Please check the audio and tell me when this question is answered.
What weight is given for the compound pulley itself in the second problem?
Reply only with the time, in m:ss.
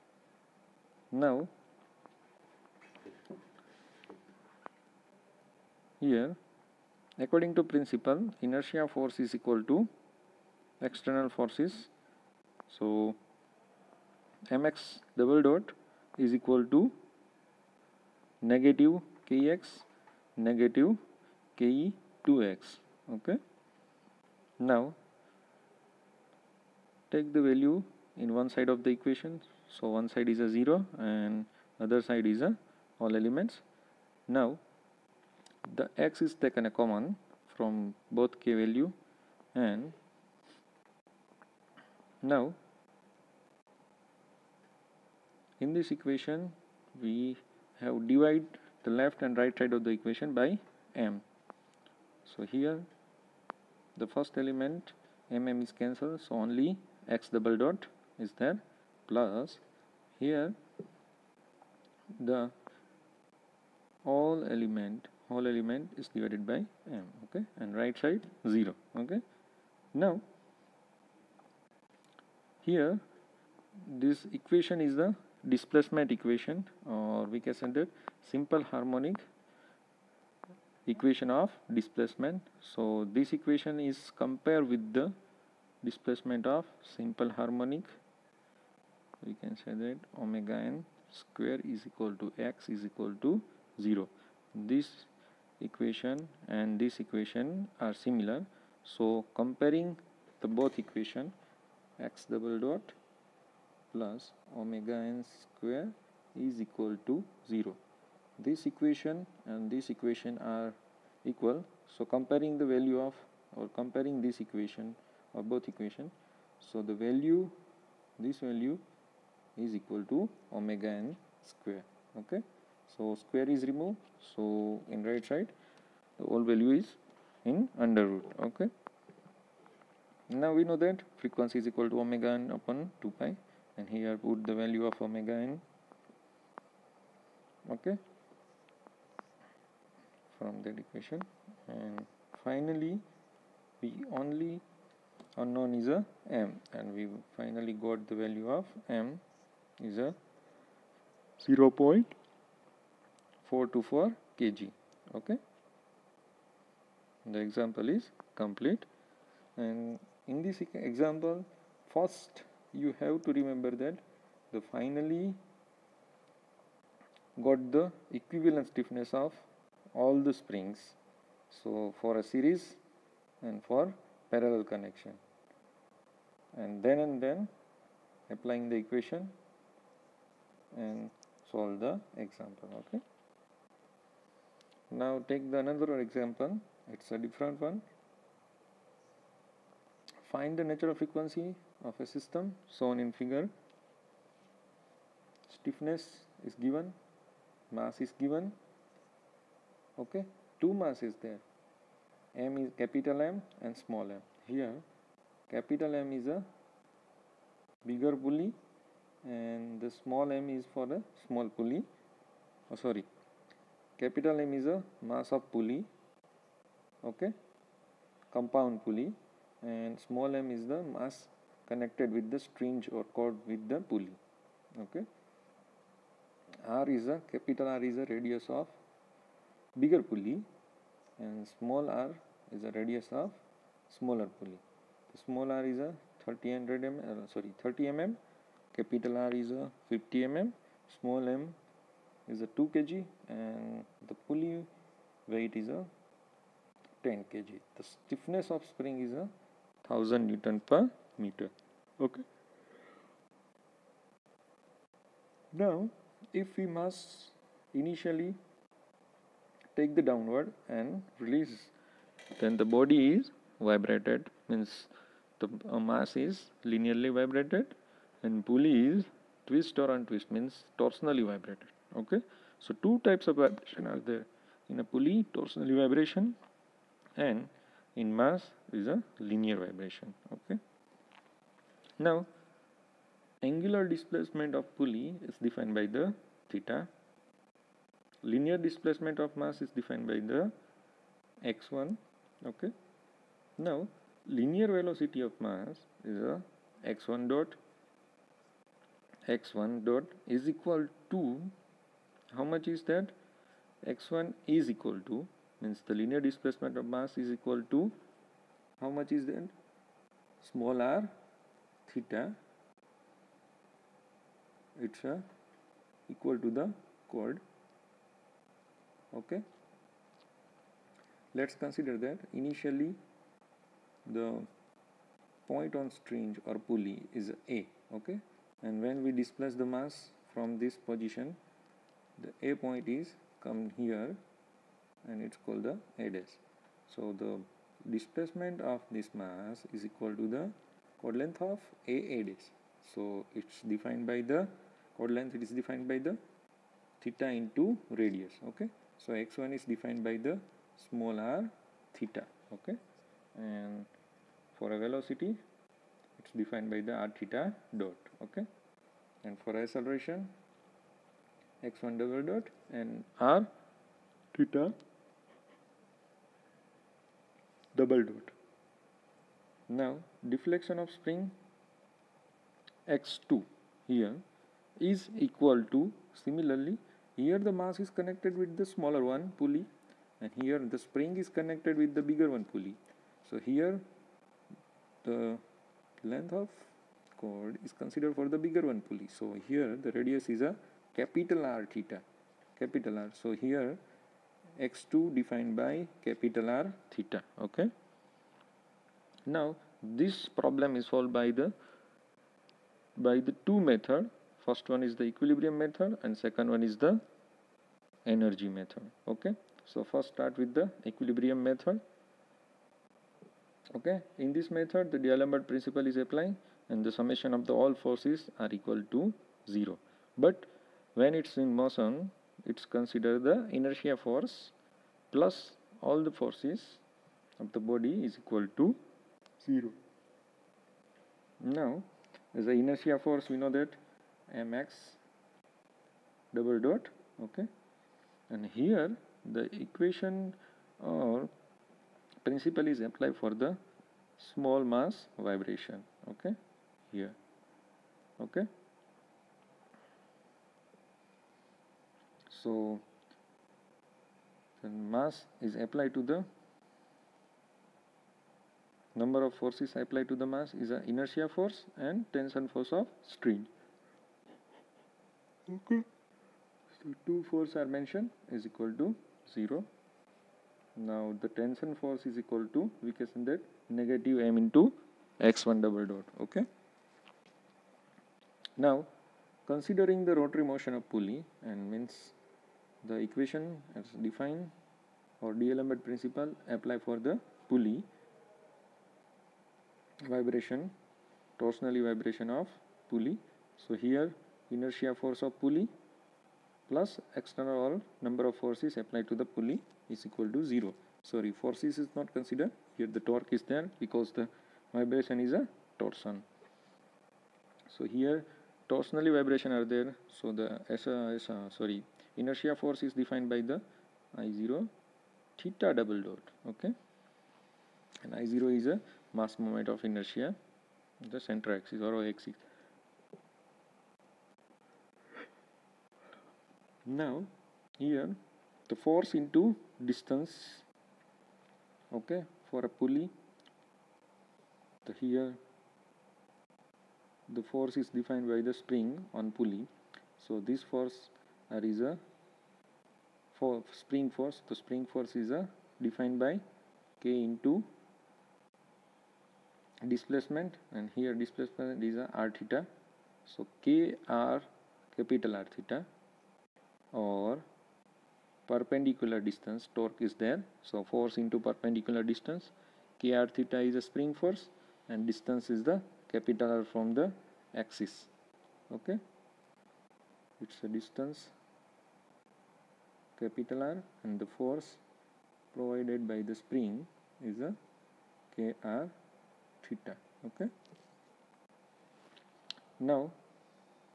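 4:07.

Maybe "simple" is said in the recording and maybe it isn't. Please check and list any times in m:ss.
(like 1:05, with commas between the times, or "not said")
1:18, 1:26.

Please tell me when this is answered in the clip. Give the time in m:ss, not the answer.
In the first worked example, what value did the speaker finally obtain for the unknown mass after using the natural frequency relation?
2:31.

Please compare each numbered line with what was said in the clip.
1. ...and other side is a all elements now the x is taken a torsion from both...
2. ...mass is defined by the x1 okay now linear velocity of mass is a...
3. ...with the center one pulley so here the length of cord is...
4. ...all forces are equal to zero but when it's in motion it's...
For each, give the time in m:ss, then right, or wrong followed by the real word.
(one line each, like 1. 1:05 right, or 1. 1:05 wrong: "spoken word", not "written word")
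1. 0:31 wrong: "common", not "torsion"
2. 4:49 right
3. 6:21 wrong: "bigger", not "center"
4. 6:57 right.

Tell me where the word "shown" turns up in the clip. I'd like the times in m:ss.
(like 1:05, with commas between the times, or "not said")
3:12.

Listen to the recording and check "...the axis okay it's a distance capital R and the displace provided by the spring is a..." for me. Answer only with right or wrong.
wrong.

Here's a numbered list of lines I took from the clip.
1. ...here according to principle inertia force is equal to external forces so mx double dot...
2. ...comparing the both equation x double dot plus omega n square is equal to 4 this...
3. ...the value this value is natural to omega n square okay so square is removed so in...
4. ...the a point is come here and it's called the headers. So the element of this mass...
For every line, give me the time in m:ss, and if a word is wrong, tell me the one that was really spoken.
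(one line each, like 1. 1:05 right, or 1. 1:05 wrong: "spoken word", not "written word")
1. 0:06 right
2. 1:39 wrong: "0", not "4"
3. 1:56 wrong: "equal", not "natural"
4. 5:32 wrong: "displacement", not "element".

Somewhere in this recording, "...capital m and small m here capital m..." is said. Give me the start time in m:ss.
3:22.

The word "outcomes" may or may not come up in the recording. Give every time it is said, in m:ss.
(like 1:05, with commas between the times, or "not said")
not said.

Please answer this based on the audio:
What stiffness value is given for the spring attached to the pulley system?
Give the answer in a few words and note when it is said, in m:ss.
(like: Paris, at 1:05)
1000 N/m, at 4:09.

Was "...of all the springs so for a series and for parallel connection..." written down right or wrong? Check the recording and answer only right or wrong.
right.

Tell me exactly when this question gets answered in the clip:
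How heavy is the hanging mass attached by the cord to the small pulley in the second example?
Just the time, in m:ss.
4:02.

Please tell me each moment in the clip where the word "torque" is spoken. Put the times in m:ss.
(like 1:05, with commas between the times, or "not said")
8:22, 9:19.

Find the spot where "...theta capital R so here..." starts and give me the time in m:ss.
6:31.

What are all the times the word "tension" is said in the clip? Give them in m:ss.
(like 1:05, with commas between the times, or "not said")
7:42, 7:51.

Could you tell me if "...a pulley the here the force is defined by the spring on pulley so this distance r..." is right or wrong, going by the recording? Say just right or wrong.
wrong.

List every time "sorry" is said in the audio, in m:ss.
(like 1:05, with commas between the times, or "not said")
3:32, 3:57, 8:21, 8:31.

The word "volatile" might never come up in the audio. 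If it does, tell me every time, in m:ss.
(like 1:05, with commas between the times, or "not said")
not said.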